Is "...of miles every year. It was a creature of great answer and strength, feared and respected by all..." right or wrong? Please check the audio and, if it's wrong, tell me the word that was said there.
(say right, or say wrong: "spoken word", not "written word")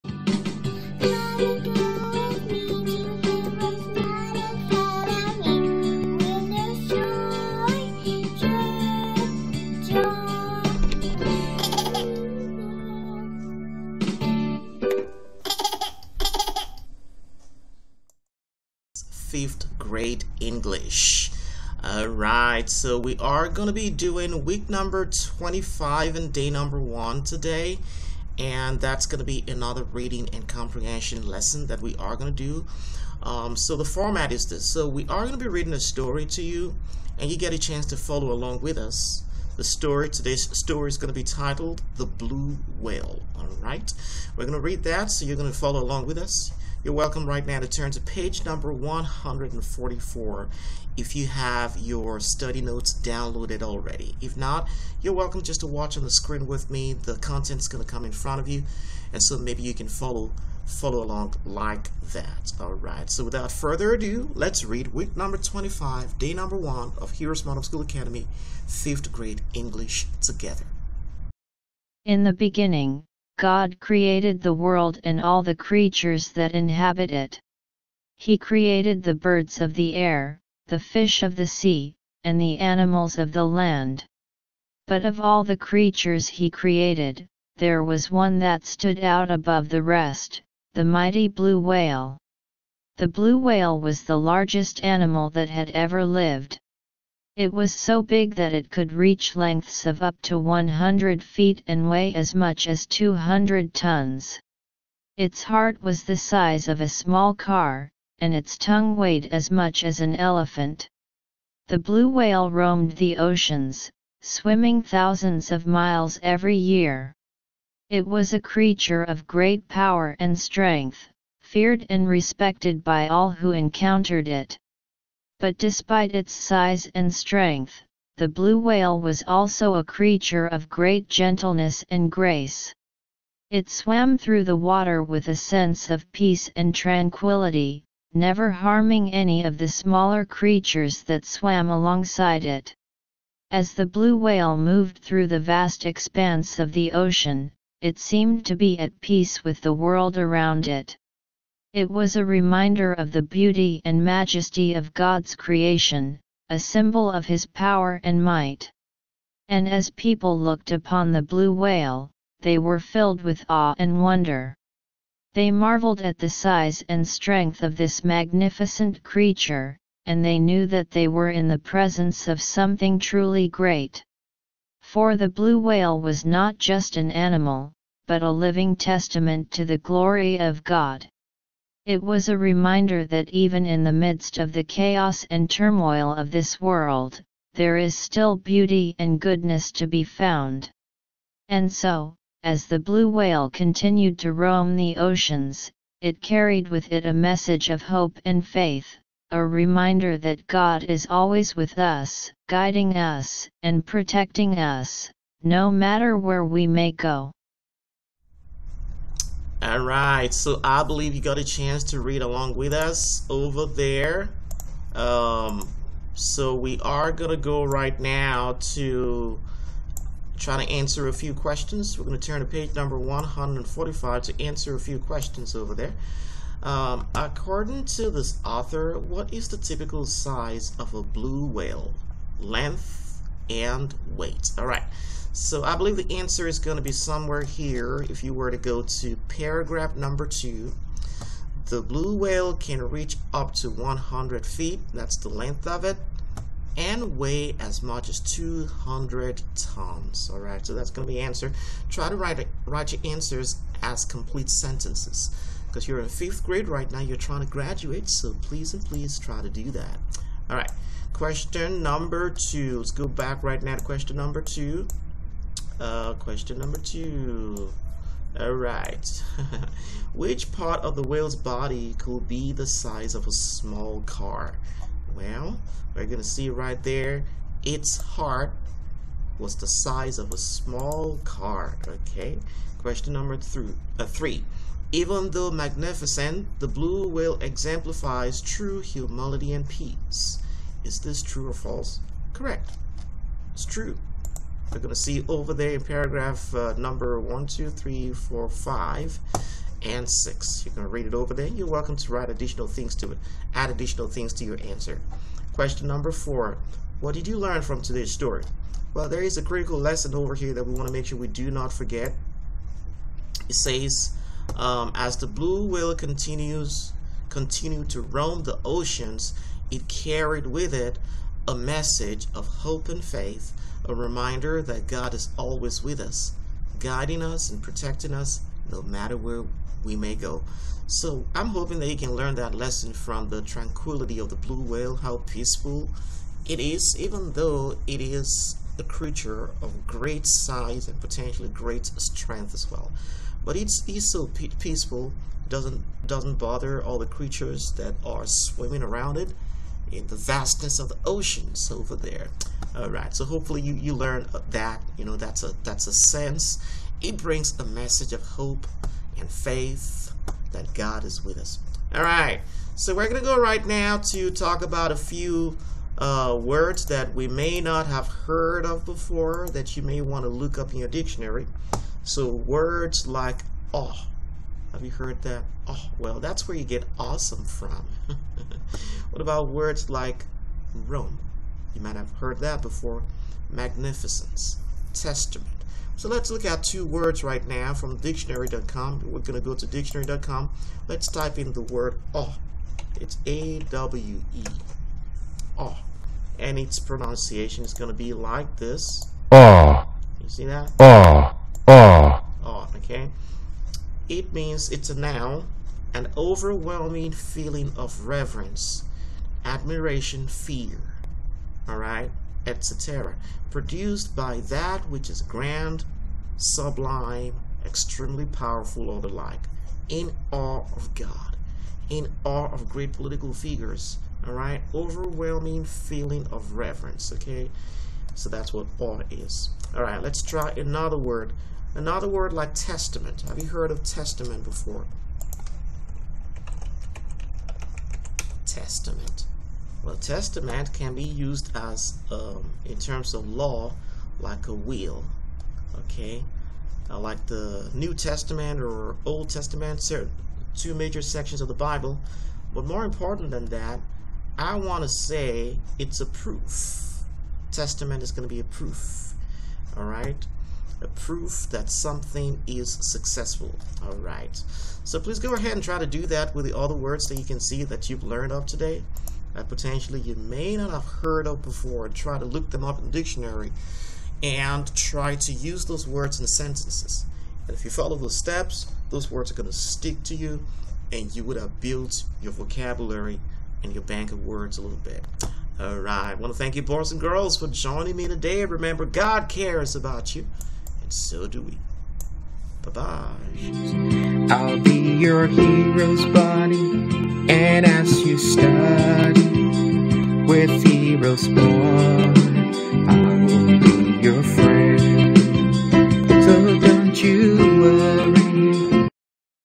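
wrong: "power", not "answer".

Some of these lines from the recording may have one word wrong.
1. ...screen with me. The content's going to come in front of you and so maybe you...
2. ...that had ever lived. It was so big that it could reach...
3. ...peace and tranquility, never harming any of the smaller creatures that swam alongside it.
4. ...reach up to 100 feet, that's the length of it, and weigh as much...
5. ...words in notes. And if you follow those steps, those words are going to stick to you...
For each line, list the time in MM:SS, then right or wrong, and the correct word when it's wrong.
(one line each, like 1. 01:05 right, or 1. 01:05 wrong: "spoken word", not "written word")
1. 00:56 right
2. 01:35 right
3. 02:16 right
4. 04:02 right
5. 07:55 wrong: "sentences", not "notes".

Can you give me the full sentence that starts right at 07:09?
All right, let's try another word Another word like testament.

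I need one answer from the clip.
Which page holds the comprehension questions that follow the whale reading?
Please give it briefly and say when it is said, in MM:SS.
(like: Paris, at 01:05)
145, at 03:42.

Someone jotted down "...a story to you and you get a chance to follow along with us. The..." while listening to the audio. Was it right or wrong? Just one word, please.
right.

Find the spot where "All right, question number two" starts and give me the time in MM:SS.
04:20.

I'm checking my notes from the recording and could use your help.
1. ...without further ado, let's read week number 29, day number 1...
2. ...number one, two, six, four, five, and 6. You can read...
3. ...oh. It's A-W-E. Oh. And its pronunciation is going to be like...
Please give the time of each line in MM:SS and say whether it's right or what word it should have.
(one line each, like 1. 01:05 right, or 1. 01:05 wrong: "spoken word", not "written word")
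1. 01:03 wrong: "25", not "29"
2. 04:56 wrong: "three", not "six"
3. 06:32 right.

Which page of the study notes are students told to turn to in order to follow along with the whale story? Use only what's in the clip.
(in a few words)
144.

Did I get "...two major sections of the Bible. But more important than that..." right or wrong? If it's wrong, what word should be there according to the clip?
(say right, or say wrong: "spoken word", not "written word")
right.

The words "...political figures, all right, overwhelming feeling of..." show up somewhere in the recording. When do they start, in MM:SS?
07:02.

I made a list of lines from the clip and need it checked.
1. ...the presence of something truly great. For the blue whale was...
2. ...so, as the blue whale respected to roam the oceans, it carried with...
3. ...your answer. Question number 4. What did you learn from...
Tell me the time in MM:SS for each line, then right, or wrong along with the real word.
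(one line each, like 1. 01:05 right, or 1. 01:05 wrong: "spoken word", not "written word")
1. 02:51 right
2. 03:11 wrong: "continued", not "respected"
3. 05:04 right.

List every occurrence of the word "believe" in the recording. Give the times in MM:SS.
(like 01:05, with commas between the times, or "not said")
03:30, 03:55.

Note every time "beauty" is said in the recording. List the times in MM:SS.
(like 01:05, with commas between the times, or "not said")
02:33, 03:08.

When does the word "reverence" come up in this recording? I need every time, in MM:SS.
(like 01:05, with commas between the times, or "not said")
06:48, 07:06.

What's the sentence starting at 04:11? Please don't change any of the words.
Try to write, write your answers as complete sentences because you're in fifth grade right now.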